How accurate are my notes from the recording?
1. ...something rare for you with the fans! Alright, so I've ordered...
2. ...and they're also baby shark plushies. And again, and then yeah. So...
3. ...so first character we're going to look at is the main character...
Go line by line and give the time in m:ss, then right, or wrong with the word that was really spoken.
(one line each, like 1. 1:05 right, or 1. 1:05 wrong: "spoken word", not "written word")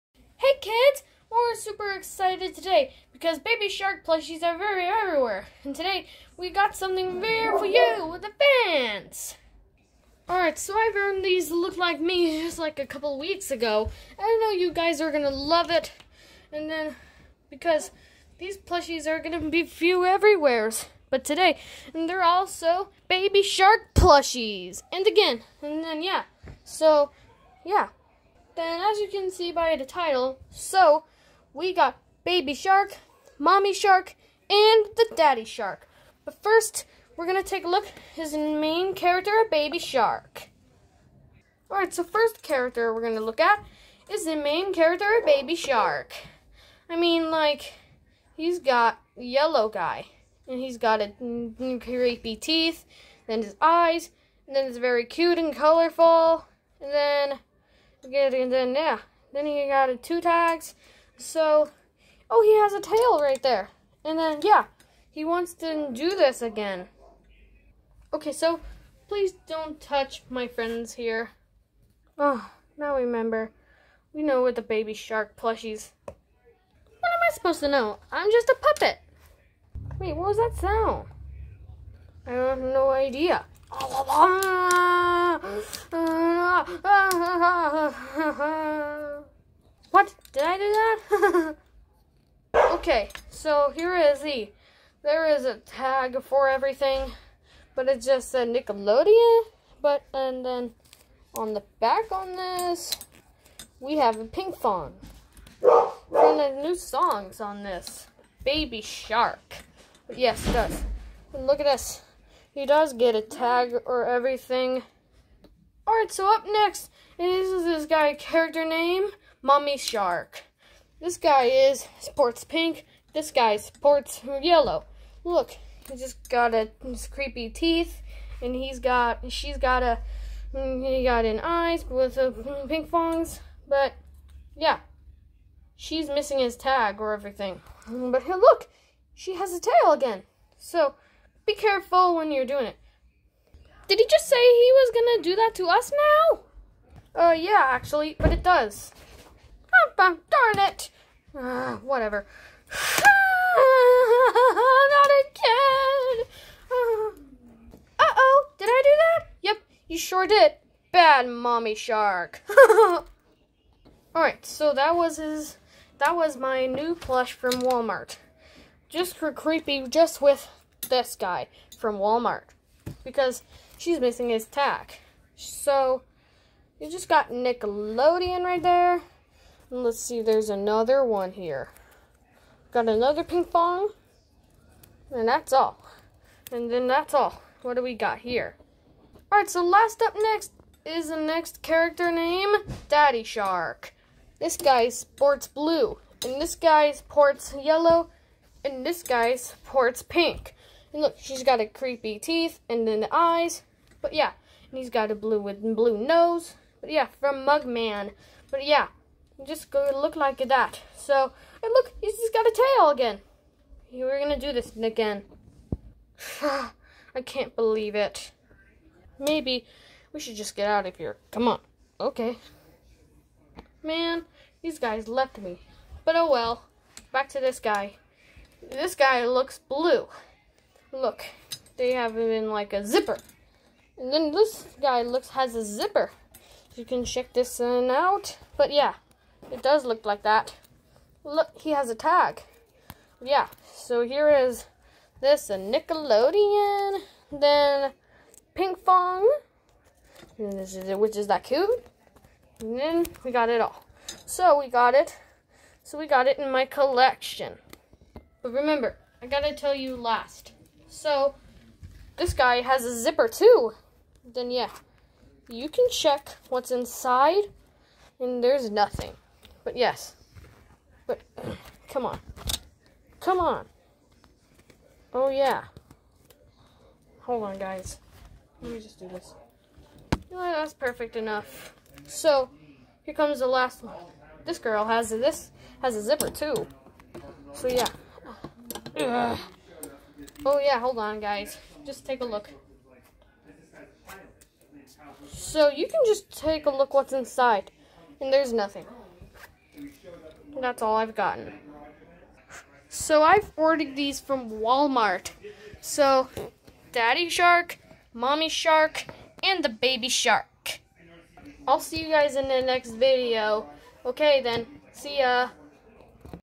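1. 0:06 wrong: "earned", not "ordered"
2. 0:21 right
3. 0:41 right.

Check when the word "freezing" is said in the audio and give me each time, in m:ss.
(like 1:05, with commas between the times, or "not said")
not said.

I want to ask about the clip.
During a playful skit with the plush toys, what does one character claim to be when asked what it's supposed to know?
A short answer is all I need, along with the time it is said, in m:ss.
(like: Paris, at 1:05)
a puppet, at 1:18.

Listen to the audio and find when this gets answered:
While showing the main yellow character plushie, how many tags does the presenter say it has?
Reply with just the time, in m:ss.
1:00.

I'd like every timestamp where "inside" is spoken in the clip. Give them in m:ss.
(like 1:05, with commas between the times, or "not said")
4:26, 4:57.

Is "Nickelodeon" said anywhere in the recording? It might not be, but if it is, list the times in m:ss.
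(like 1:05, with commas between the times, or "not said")
1:38, 2:57, 4:05.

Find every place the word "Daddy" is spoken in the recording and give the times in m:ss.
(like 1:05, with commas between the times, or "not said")
0:35, 3:12, 5:06.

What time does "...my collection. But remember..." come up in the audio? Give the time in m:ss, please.
4:16.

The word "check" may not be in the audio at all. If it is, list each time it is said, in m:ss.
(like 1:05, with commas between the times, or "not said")
3:57, 4:25.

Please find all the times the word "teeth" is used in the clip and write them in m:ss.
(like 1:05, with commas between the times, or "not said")
0:52, 2:07, 3:22.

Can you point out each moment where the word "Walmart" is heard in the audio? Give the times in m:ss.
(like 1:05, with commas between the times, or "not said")
2:47, 2:51, 5:04.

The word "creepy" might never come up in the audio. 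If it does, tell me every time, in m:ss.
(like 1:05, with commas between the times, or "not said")
0:51, 2:07, 2:49, 3:21.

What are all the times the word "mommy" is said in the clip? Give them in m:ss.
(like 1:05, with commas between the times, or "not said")
0:33, 2:41, 5:08.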